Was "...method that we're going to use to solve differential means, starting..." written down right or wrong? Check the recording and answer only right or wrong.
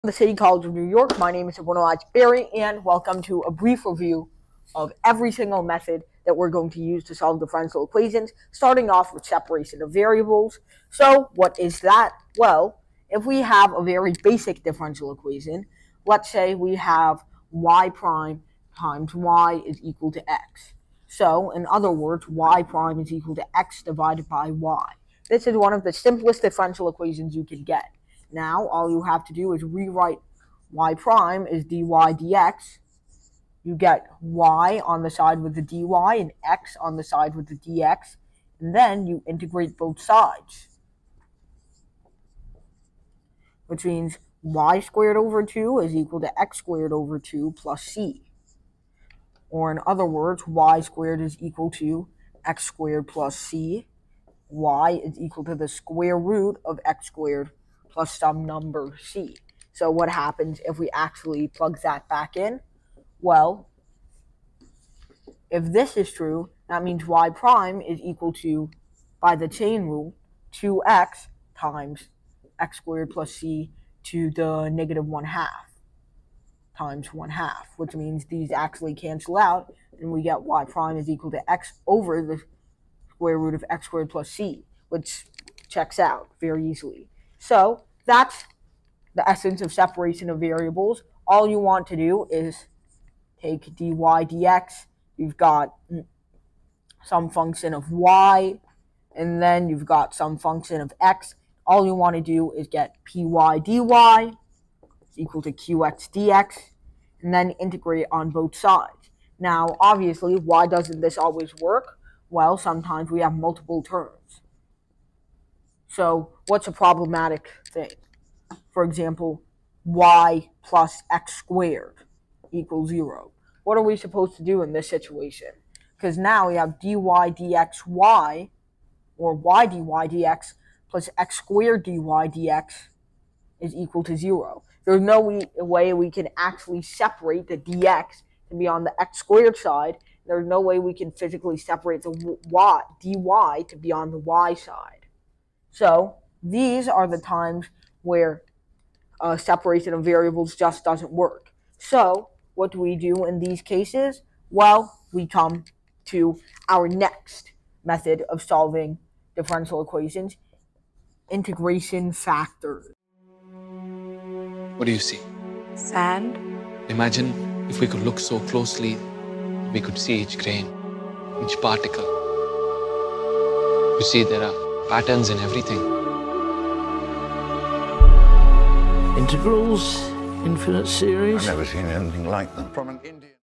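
wrong.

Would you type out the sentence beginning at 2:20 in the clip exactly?
There's no way we can physically separate the y, dy to be on the y side.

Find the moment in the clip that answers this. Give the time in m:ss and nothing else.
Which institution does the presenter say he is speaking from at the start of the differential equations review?
0:00.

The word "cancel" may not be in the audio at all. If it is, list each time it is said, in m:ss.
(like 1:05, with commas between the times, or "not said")
1:18.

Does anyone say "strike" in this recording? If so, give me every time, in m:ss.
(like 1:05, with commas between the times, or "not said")
not said.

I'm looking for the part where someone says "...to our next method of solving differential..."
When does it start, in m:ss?
2:36.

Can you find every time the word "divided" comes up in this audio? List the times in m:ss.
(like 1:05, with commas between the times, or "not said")
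0:23.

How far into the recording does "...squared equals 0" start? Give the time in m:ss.
2:01.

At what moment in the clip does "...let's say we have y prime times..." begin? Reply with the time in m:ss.
0:16.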